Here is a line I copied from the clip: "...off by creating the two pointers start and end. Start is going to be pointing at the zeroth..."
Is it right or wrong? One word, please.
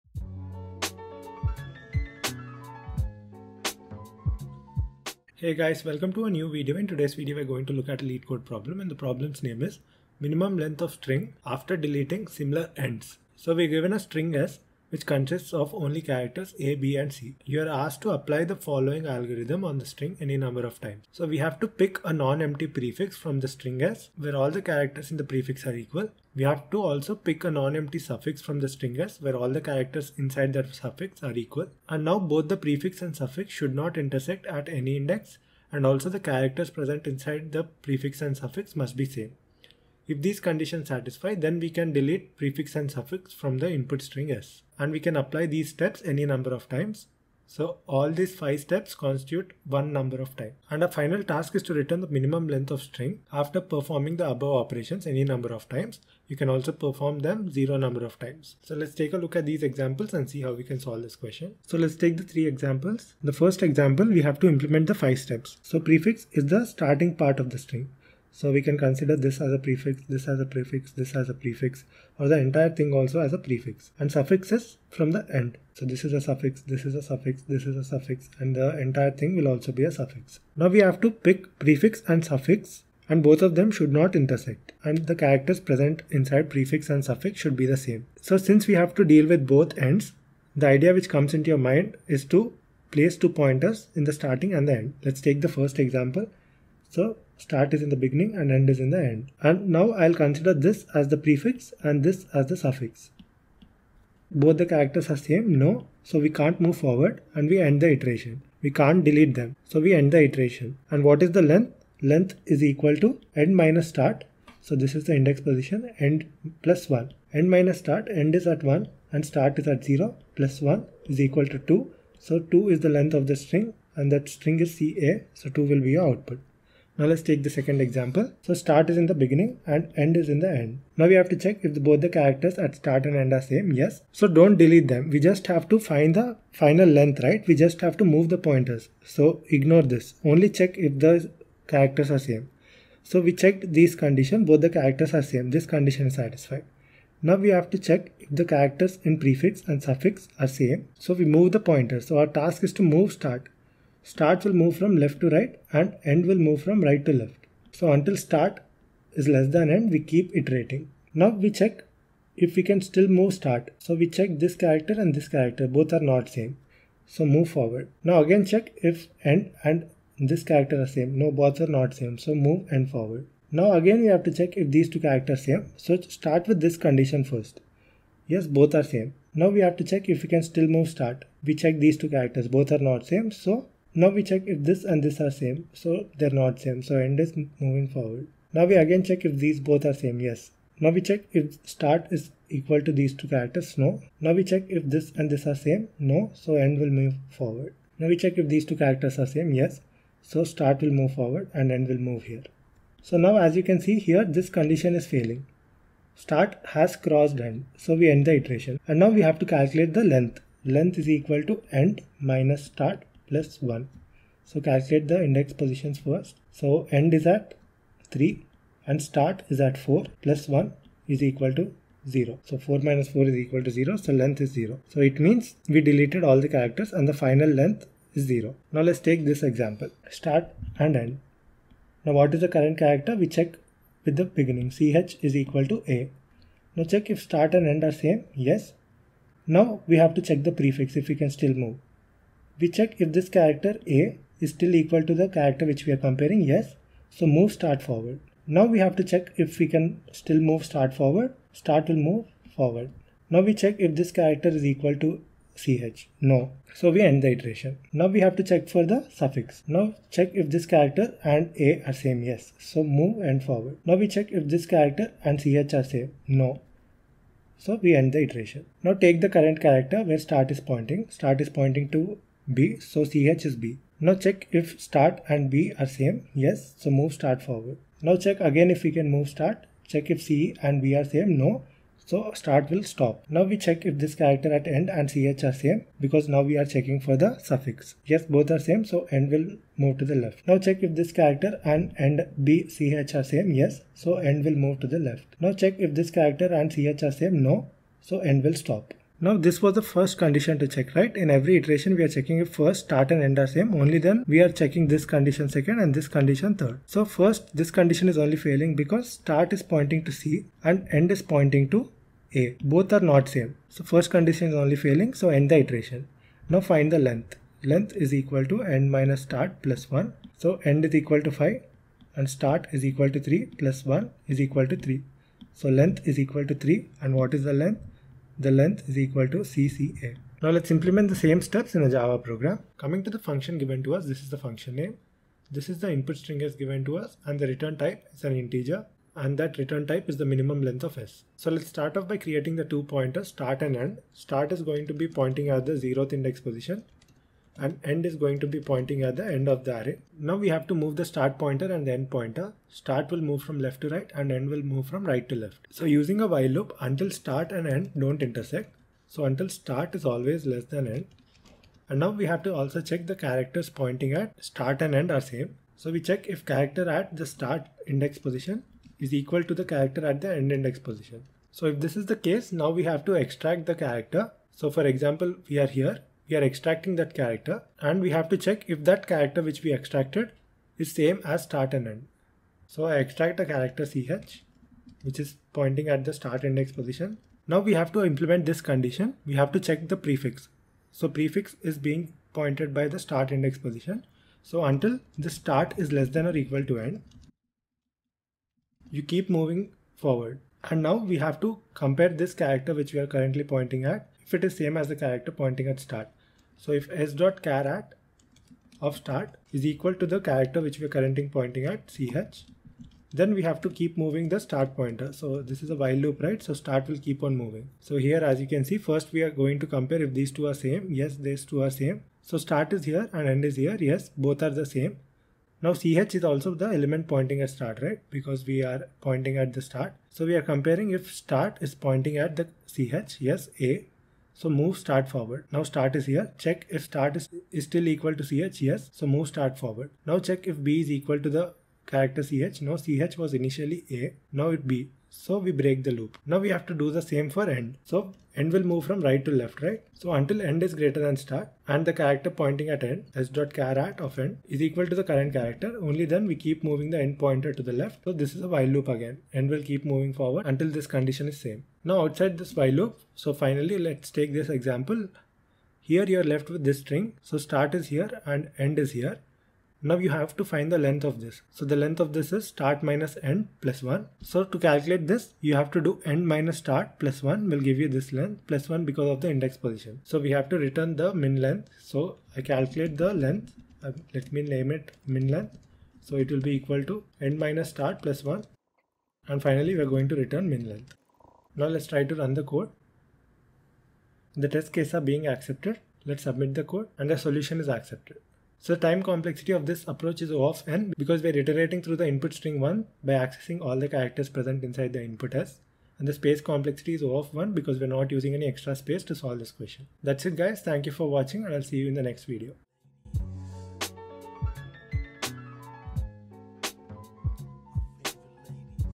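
right.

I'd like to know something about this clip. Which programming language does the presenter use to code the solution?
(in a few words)
Java.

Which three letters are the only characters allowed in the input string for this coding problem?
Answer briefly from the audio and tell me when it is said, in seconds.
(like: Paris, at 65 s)
A, B and C, at 16 s.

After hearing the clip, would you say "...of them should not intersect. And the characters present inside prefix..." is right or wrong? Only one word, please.
right.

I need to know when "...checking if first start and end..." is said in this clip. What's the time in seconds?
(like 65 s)
302 s.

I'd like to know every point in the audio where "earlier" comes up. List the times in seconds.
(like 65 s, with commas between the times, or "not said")
not said.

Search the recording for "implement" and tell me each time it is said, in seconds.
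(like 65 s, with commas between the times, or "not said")
64 s, 330 s, 388 s.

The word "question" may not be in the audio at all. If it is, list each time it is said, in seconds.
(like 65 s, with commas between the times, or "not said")
61 s, 509 s.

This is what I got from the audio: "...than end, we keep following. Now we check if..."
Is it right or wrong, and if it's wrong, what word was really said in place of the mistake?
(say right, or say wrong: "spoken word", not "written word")
wrong: "iterating", not "following".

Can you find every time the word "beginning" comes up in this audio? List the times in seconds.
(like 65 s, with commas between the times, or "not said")
97 s, 129 s, 234 s.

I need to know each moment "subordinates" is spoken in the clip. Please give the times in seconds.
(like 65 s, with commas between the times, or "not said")
not said.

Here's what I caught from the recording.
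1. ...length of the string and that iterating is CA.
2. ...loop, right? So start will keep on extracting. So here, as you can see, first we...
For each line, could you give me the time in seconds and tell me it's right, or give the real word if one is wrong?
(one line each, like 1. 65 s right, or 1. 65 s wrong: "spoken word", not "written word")
1. 122 s wrong: "string", not "iterating"
2. 415 s wrong: "moving", not "extracting".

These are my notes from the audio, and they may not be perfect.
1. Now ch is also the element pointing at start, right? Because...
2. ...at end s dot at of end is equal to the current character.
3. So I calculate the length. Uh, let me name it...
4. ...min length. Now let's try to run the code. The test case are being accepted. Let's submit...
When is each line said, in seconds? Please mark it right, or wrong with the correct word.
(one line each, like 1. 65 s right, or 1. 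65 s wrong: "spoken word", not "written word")
1. 425 s right
2. 452 s right
3. 481 s right
4. 490 s right.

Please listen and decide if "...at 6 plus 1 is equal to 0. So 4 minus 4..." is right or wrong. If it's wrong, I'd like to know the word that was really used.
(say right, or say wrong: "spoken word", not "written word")
wrong: "4", not "6".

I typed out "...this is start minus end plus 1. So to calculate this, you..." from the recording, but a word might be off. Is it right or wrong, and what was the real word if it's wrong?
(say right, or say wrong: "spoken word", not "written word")
right.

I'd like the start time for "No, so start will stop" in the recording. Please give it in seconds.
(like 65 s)
281 s.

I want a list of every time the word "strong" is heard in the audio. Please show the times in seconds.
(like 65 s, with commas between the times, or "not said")
not said.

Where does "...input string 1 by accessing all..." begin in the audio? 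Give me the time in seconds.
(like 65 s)
502 s.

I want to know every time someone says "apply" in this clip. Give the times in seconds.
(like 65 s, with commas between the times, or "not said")
18 s, 45 s.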